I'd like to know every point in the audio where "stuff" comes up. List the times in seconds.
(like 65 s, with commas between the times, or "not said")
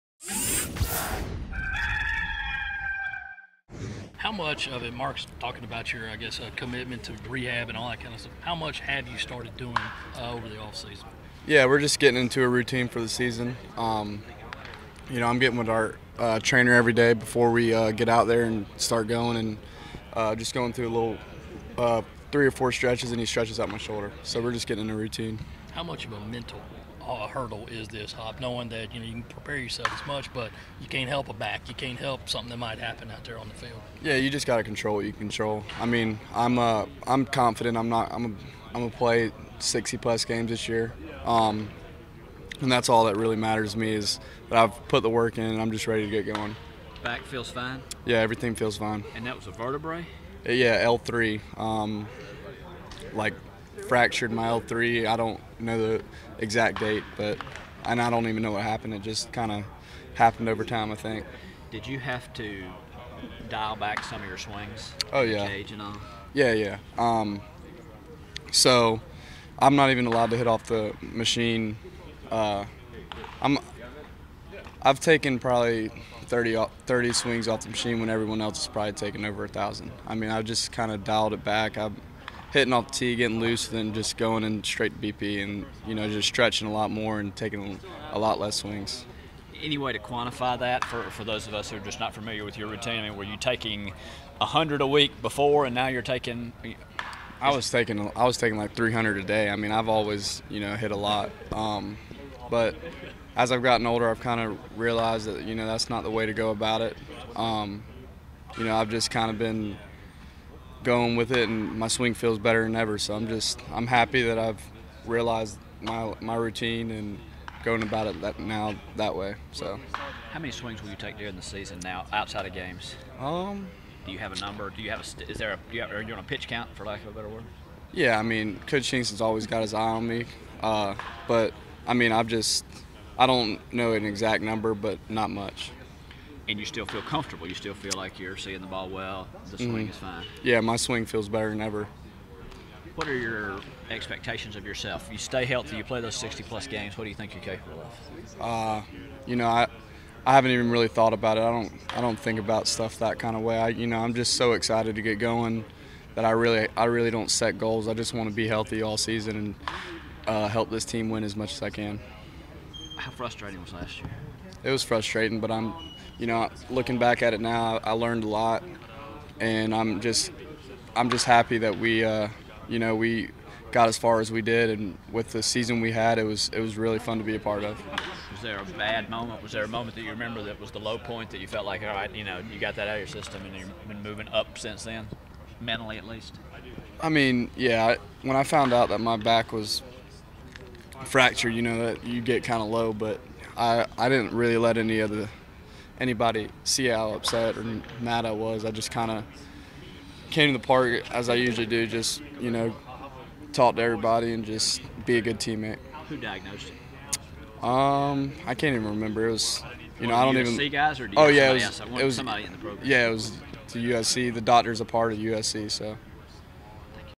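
8 s, 152 s.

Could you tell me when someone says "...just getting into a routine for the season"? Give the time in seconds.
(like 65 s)
11 s.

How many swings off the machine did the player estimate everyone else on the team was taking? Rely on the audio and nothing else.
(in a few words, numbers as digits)
over 1,000.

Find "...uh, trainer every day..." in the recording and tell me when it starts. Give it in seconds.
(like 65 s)
16 s.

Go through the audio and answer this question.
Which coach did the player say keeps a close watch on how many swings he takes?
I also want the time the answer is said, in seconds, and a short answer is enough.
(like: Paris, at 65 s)
Coach Kingston, at 128 s.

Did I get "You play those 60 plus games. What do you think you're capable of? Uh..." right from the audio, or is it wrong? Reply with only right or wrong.
right.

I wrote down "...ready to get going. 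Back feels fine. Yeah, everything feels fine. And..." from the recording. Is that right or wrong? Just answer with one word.
right.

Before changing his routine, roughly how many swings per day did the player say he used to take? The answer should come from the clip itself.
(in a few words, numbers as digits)
300 a day.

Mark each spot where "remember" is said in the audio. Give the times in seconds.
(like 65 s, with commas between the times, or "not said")
180 s, 208 s.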